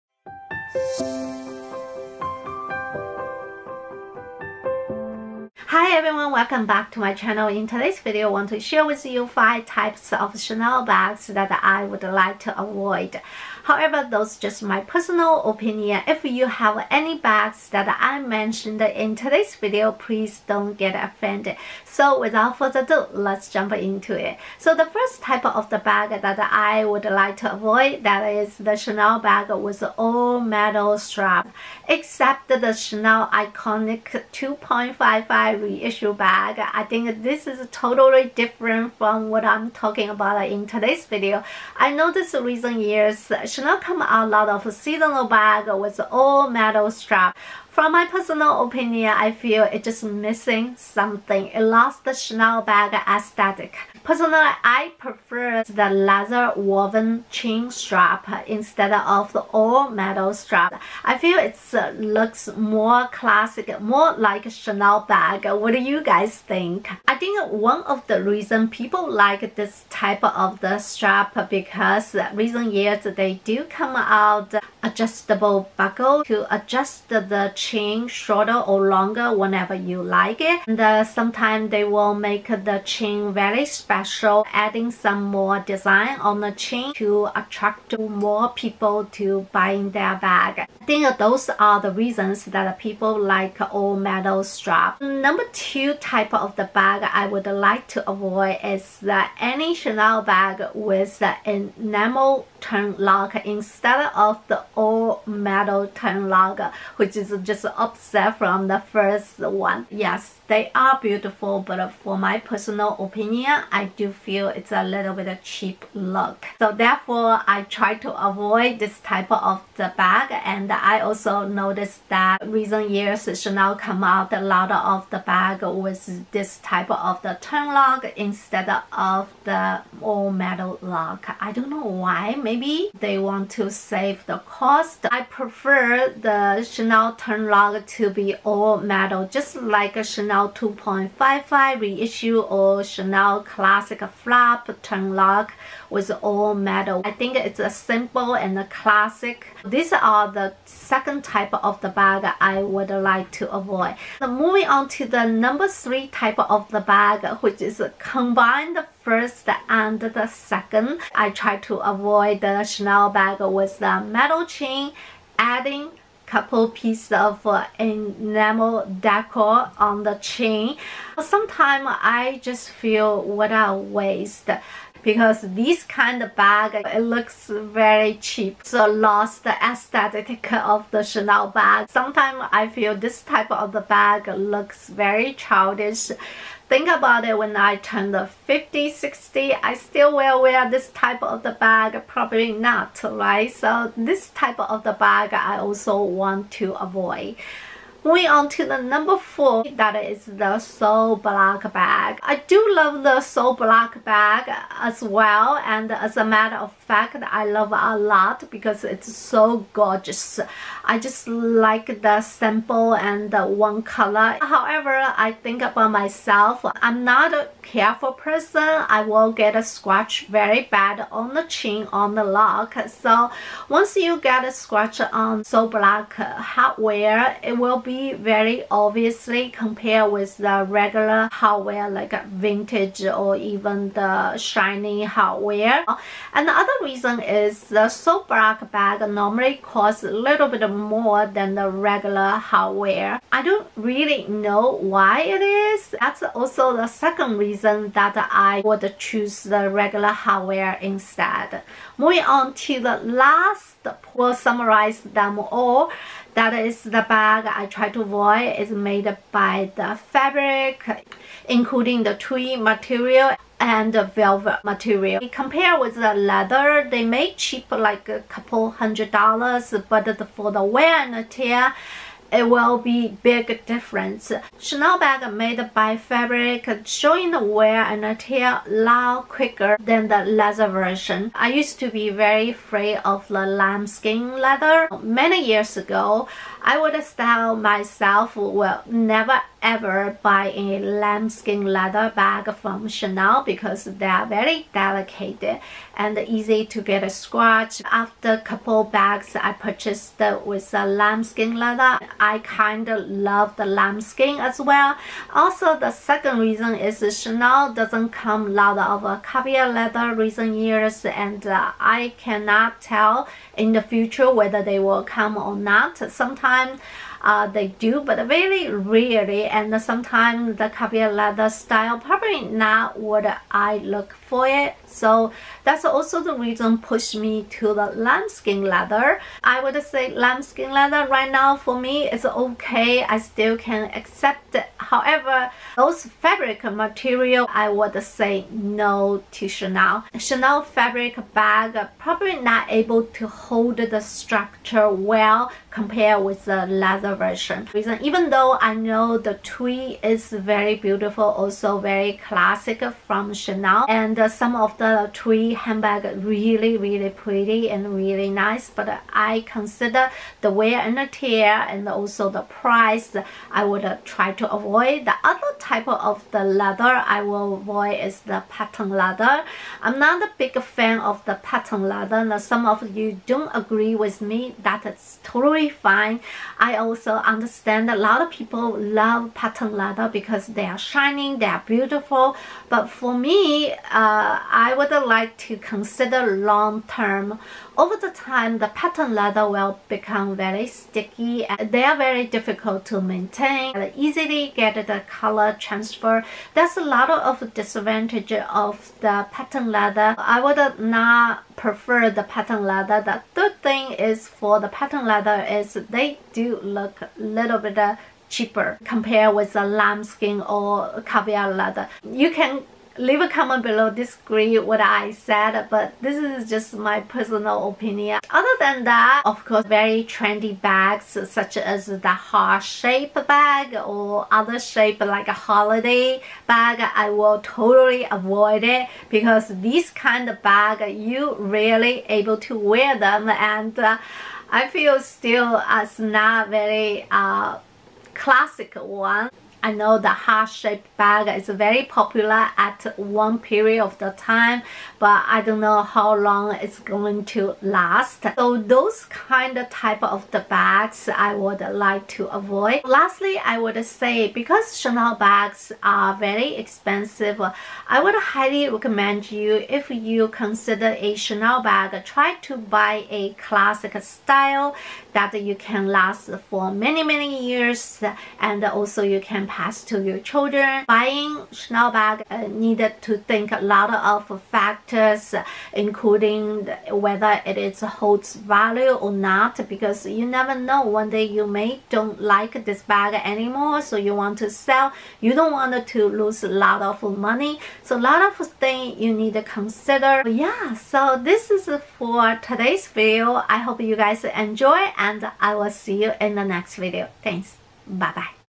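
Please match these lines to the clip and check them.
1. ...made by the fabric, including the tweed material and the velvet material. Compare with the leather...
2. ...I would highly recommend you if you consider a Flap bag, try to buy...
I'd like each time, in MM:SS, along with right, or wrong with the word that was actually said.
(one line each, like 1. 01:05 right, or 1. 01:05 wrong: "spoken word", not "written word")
1. 04:18 right
2. 07:37 wrong: "Chanel", not "Flap".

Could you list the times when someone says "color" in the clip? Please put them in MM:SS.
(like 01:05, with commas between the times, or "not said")
03:33, 06:35.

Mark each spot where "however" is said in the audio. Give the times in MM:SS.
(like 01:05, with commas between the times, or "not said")
00:13, 03:34, 05:34.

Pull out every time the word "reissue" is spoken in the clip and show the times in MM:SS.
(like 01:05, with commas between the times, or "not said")
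00:35, 02:21.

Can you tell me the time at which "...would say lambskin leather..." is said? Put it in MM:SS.
05:29.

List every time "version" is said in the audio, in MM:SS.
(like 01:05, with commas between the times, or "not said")
04:40, 05:47.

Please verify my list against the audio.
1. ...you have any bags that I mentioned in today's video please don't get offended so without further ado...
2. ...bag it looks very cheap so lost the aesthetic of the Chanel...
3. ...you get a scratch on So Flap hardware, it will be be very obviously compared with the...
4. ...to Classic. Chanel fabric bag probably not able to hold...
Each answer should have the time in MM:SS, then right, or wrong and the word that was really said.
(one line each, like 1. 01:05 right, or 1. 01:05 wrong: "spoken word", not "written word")
1. 00:16 right
2. 02:56 right
3. 03:43 wrong: "Black", not "Flap"
4. 05:39 wrong: "Chanel", not "Classic".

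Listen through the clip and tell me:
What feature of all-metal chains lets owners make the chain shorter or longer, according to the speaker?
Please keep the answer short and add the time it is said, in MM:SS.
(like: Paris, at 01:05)
adjustable buckle, at 01:14.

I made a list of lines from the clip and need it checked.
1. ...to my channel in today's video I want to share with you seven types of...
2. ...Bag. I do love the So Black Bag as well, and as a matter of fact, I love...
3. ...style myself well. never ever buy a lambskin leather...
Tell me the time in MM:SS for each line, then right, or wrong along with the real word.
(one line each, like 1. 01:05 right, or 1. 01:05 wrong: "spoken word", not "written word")
1. 00:06 wrong: "five", not "seven"
2. 03:21 right
3. 04:47 right.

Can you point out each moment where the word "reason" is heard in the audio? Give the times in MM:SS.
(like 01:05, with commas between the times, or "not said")
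01:08, 01:12, 01:31, 03:56, 04:07, 05:06, 05:26, 05:47.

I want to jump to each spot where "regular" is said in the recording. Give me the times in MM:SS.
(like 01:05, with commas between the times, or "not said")
03:50, 04:01, 04:09.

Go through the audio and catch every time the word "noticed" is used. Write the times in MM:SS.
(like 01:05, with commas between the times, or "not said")
00:42, 02:01.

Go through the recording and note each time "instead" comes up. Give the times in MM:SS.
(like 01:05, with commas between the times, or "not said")
00:58, 01:43, 02:08, 04:10.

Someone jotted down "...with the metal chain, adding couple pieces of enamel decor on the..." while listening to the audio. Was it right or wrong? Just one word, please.
right.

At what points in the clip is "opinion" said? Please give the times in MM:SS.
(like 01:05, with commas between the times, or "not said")
00:15, 00:48, 01:52, 06:57.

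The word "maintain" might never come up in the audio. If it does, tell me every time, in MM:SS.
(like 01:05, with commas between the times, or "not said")
06:32.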